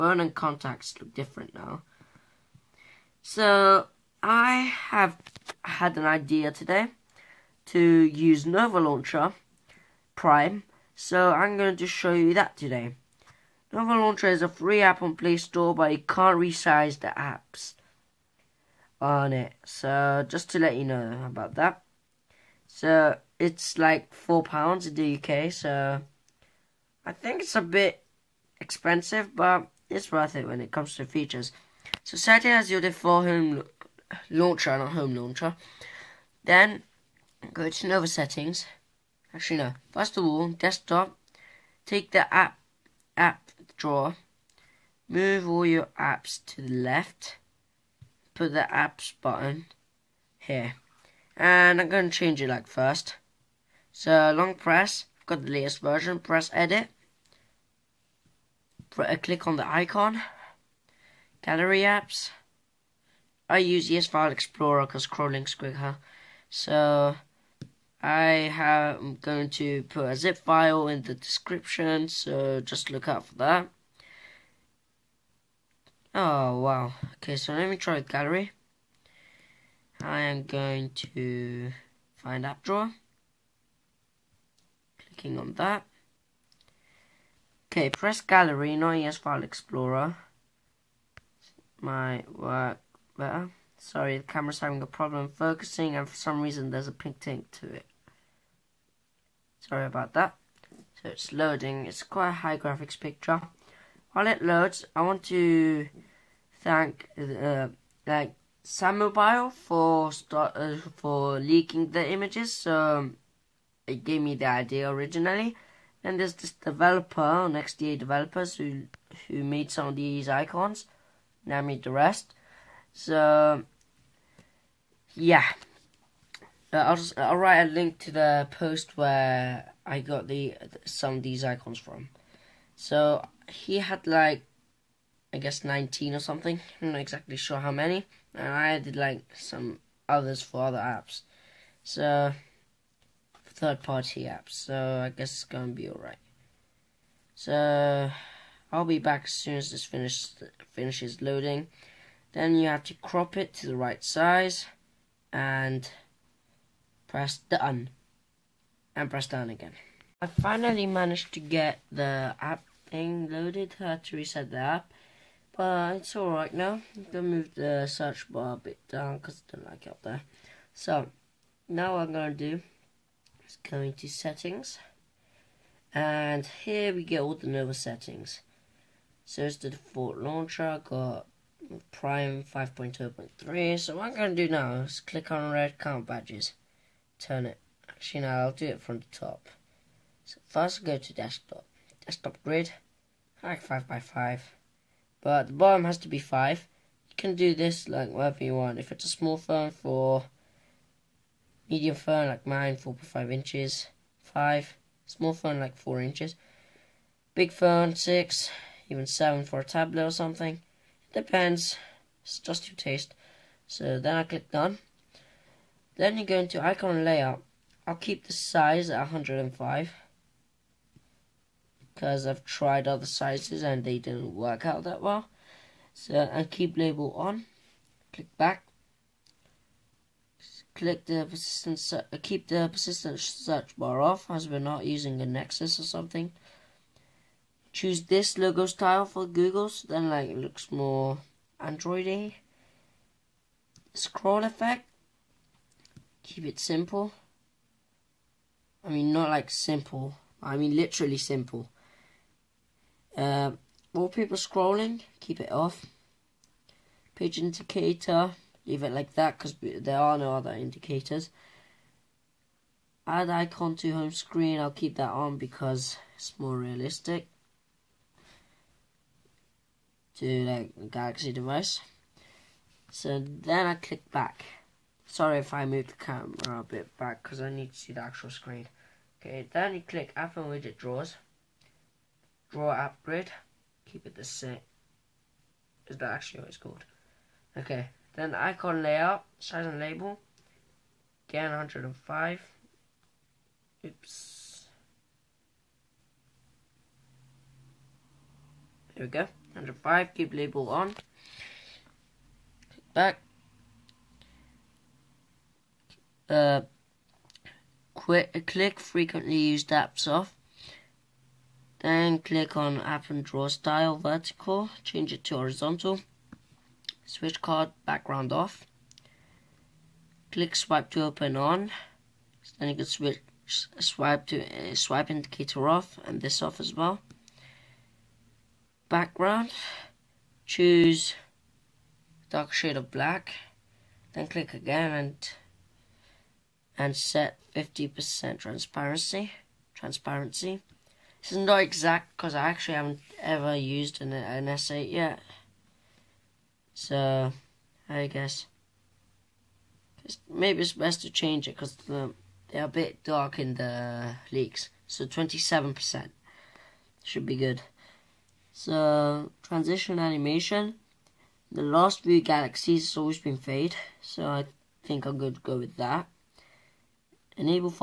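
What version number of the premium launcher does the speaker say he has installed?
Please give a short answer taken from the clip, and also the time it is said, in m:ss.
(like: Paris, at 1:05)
5.2.3, at 3:02.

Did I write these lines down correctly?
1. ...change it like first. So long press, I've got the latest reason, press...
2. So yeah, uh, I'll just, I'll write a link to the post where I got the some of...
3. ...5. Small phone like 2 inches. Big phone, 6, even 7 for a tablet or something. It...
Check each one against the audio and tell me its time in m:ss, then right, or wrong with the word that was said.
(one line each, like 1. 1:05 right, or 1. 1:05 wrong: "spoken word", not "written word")
1. 0:52 wrong: "version", not "reason"
2. 2:02 right
3. 3:24 wrong: "4", not "2".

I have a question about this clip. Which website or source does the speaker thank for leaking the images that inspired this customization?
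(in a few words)
SamMobile.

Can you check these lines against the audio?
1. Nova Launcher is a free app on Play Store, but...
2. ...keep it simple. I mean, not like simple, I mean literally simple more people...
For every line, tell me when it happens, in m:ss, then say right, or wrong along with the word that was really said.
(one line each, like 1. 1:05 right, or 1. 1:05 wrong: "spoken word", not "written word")
1. 0:13 right
2. 4:06 right.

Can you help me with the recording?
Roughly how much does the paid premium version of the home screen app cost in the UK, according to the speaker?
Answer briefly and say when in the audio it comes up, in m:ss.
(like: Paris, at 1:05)
4 pounds, at 0:24.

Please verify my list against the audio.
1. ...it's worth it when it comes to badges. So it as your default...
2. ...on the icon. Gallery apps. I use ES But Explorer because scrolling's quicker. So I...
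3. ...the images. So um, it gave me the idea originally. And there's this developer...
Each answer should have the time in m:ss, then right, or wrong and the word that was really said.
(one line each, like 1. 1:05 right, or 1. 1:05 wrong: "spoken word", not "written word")
1. 0:29 wrong: "features", not "badges"
2. 0:59 wrong: "File", not "But"
3. 1:51 right.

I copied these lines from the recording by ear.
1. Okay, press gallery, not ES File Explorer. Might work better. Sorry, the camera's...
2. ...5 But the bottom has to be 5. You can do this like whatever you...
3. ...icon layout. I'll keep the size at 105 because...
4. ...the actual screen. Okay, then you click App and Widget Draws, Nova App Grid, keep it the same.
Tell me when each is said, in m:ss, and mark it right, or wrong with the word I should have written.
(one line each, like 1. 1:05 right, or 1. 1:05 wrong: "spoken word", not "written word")
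1. 1:27 right
2. 3:14 right
3. 3:36 right
4. 4:37 wrong: "Draw", not "Nova".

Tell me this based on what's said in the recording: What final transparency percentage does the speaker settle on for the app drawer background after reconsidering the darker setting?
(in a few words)
27%.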